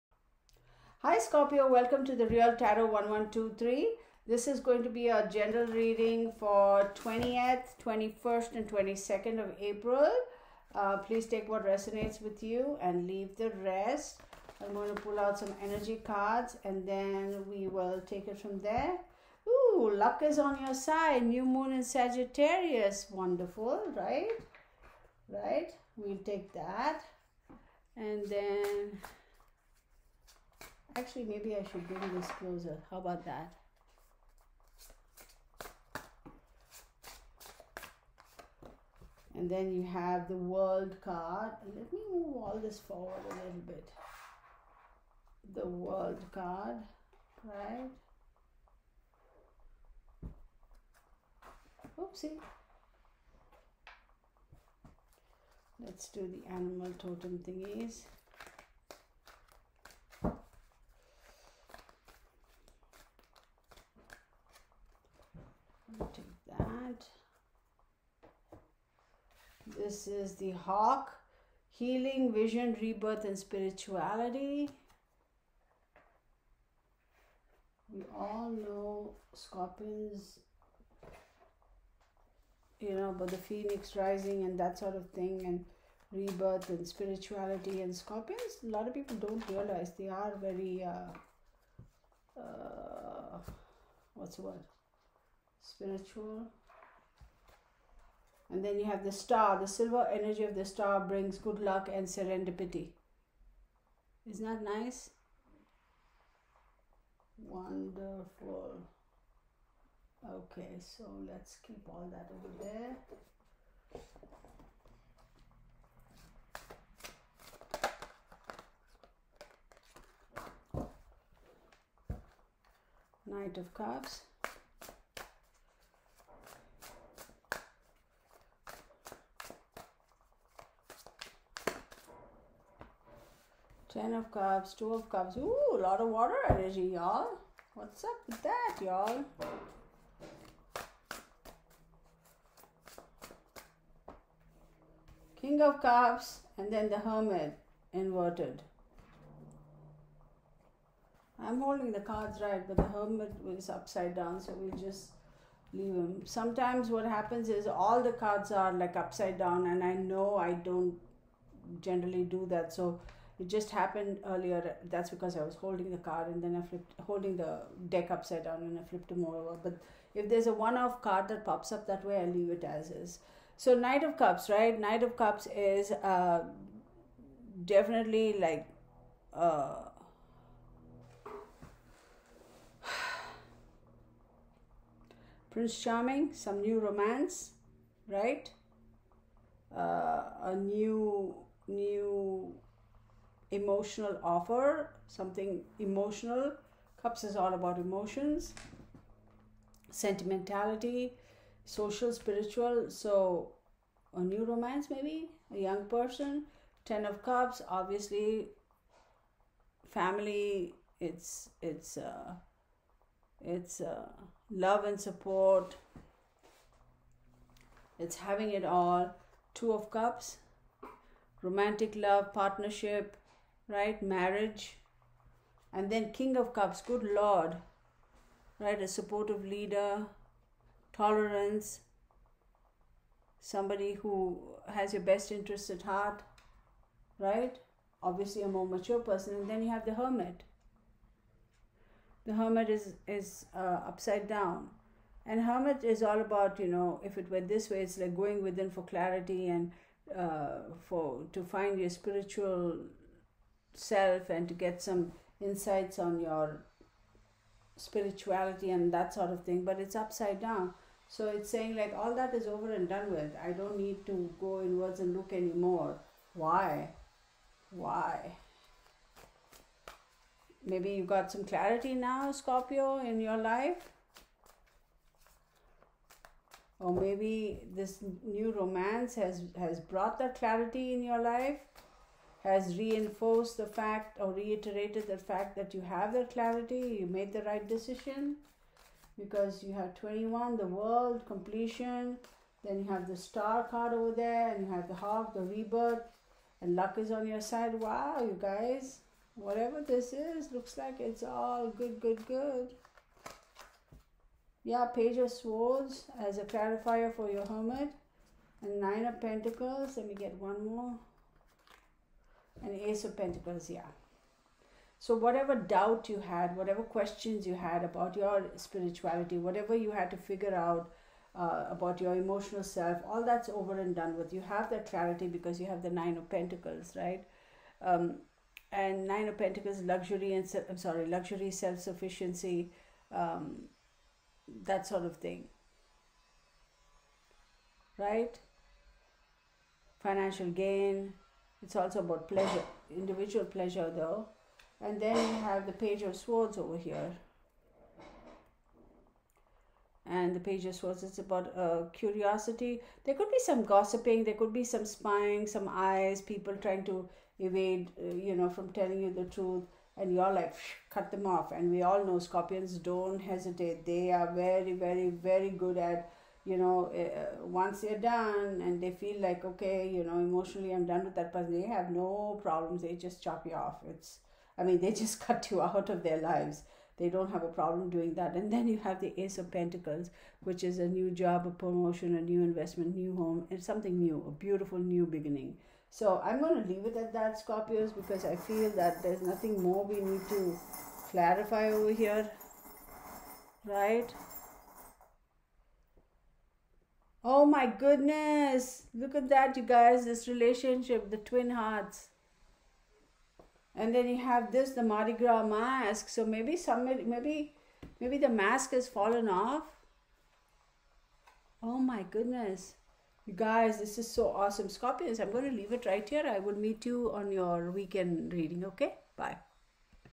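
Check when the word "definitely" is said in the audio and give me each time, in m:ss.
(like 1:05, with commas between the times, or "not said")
2:57.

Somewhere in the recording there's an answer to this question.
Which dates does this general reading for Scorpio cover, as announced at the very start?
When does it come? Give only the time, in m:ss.
0:06.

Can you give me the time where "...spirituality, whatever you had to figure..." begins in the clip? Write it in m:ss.
5:18.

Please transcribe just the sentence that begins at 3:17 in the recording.
Cups is all about emotions, sentimentality, social, spiritual.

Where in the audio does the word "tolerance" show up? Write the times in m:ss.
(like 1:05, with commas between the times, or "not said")
3:50.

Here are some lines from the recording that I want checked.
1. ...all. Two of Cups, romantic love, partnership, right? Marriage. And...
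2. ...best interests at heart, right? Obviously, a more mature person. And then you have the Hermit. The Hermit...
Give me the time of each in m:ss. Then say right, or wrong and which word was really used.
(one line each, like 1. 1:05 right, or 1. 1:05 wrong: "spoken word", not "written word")
1. 3:38 right
2. 3:55 right.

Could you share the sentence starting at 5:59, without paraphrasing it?
And you're like, cut them off.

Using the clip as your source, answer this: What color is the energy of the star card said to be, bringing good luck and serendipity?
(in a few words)
Silver.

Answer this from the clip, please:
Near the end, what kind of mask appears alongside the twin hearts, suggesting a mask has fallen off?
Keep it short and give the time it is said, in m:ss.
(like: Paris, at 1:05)
Mardi Gras mask, at 6:44.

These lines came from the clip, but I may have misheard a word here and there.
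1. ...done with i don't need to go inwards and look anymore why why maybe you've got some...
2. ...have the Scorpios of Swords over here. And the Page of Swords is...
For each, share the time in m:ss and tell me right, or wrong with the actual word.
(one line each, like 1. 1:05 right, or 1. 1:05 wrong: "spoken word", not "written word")
1. 4:22 right
2. 5:45 wrong: "Page", not "Scorpios".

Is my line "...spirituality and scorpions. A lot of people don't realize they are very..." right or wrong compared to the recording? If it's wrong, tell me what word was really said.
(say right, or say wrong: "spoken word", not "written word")
right.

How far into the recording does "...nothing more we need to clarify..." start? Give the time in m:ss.
6:29.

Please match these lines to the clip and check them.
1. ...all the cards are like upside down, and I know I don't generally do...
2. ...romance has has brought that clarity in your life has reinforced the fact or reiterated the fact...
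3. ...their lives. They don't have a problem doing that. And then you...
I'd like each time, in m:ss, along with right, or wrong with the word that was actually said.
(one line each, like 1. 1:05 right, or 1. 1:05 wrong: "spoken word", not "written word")
1. 2:37 right
2. 4:38 right
3. 6:16 right.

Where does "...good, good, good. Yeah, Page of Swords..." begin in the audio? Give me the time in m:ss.
5:01.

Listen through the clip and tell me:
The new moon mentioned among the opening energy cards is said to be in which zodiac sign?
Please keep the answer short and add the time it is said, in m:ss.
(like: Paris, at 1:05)
Sagittarius, at 0:21.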